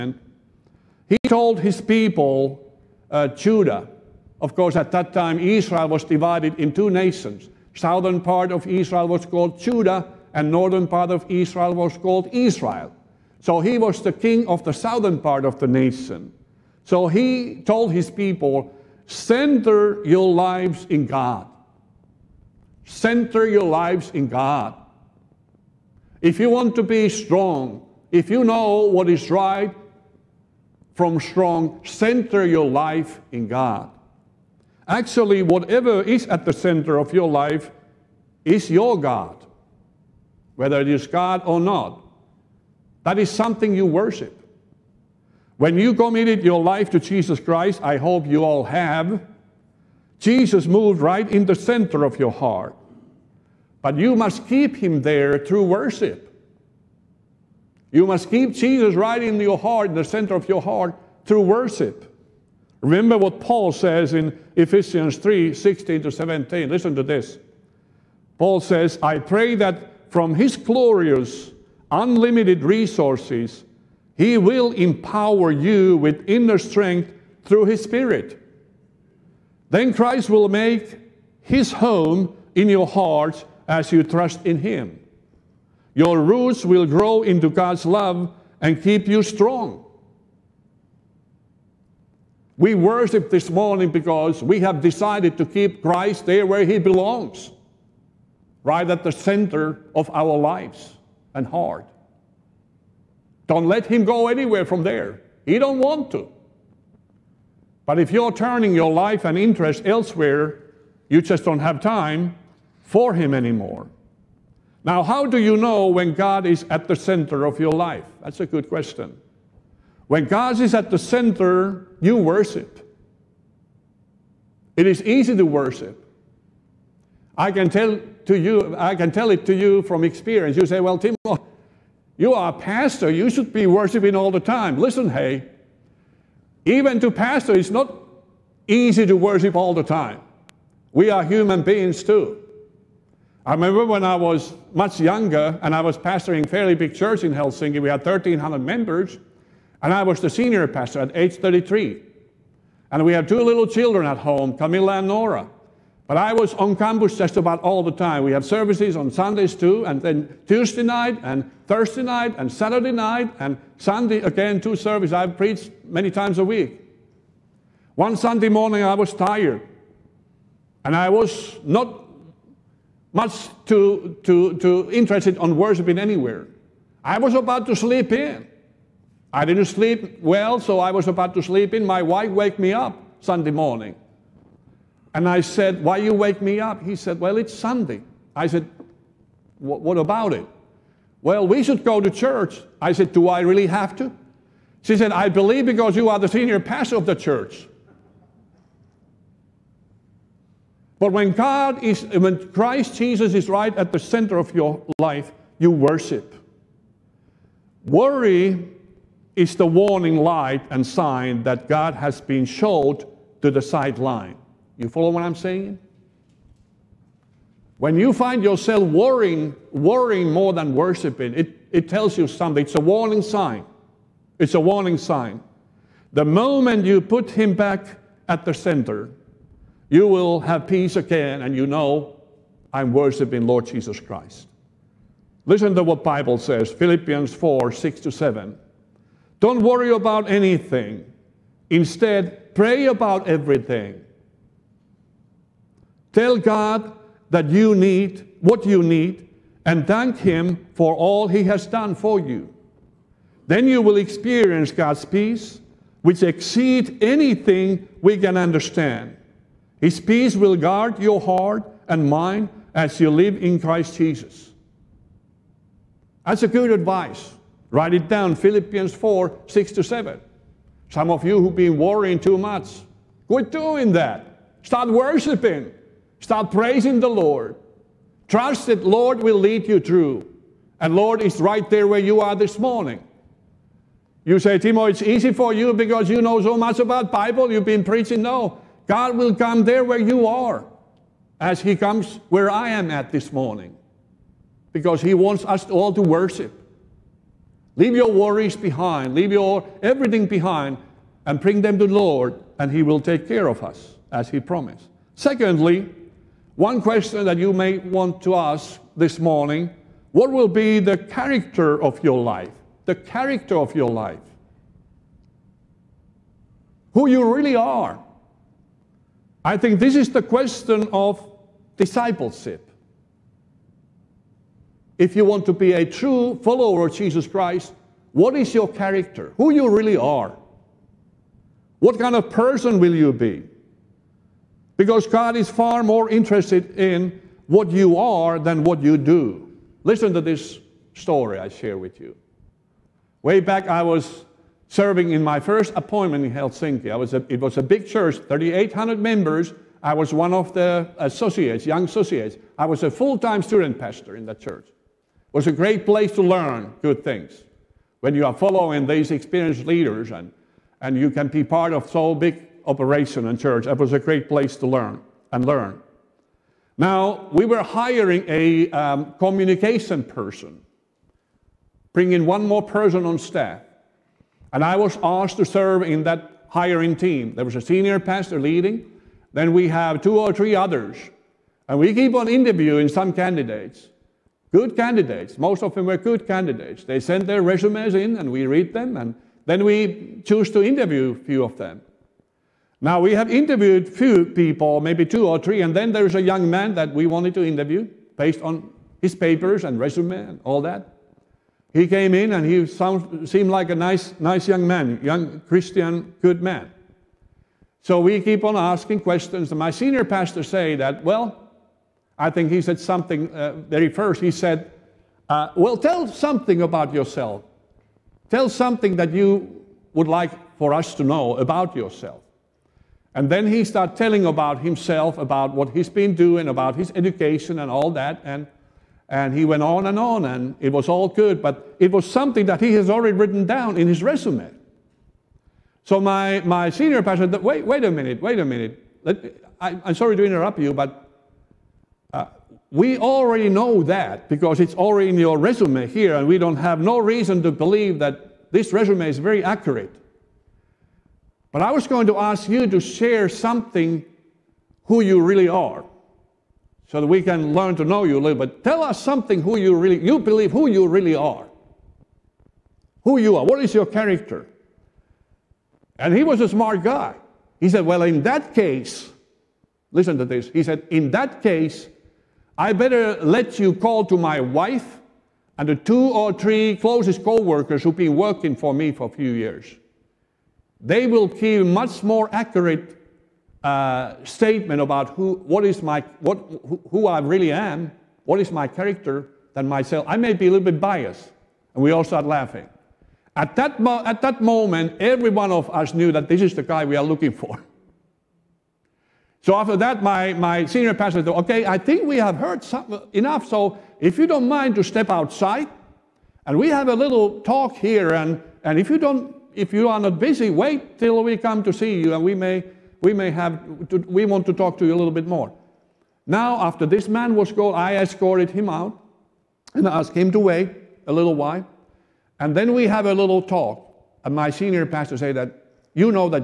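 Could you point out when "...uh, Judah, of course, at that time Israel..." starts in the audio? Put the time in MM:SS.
00:03.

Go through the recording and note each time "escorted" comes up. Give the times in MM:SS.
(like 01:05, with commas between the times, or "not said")
08:37.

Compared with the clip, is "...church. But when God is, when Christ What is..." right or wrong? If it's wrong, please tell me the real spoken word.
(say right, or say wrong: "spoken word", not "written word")
wrong: "Jesus", not "What".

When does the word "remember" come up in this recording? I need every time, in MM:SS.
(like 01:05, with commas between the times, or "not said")
01:02, 02:23.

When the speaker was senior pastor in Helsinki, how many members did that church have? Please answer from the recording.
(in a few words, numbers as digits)
1,300.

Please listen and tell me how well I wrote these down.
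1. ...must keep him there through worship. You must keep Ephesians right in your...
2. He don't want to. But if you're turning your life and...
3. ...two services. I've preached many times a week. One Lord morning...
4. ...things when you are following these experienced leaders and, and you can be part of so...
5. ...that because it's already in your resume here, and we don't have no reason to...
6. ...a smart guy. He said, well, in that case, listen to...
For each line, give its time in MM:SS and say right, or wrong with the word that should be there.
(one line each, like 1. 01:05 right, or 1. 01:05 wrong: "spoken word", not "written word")
1. 00:54 wrong: "Jesus", not "Ephesians"
2. 01:45 right
3. 02:44 wrong: "Sunday", not "Lord"
4. 05:57 right
5. 07:23 right
6. 07:46 right.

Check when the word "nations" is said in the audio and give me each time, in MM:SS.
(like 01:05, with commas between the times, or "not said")
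00:06, 00:15.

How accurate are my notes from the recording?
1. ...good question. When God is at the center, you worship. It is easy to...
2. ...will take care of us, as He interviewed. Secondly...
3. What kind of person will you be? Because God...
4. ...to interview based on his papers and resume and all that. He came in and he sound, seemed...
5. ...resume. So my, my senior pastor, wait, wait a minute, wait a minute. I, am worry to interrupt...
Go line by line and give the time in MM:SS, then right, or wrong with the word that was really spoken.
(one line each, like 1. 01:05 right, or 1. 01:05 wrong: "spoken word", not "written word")
1. 01:58 right
2. 05:02 wrong: "promised", not "interviewed"
3. 05:31 right
4. 06:37 right
5. 07:14 wrong: "sorry", not "worry".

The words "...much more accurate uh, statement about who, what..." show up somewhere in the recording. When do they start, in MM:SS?
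08:01.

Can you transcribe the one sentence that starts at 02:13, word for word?
You should be worshiping all the time.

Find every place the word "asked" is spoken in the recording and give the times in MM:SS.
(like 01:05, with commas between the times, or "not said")
06:15, 08:39.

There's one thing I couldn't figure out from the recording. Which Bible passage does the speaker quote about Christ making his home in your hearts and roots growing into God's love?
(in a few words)
Ephesians 3:16-17.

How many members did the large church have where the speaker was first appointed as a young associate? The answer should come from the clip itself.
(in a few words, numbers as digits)
3,800.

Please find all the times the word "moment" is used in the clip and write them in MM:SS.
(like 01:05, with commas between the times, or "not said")
03:46, 08:14.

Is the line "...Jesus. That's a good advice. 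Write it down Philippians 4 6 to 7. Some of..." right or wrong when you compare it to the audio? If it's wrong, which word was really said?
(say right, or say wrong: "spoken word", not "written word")
right.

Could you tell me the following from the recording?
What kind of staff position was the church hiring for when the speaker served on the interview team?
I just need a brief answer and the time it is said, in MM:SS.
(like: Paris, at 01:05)
communication person, at 06:09.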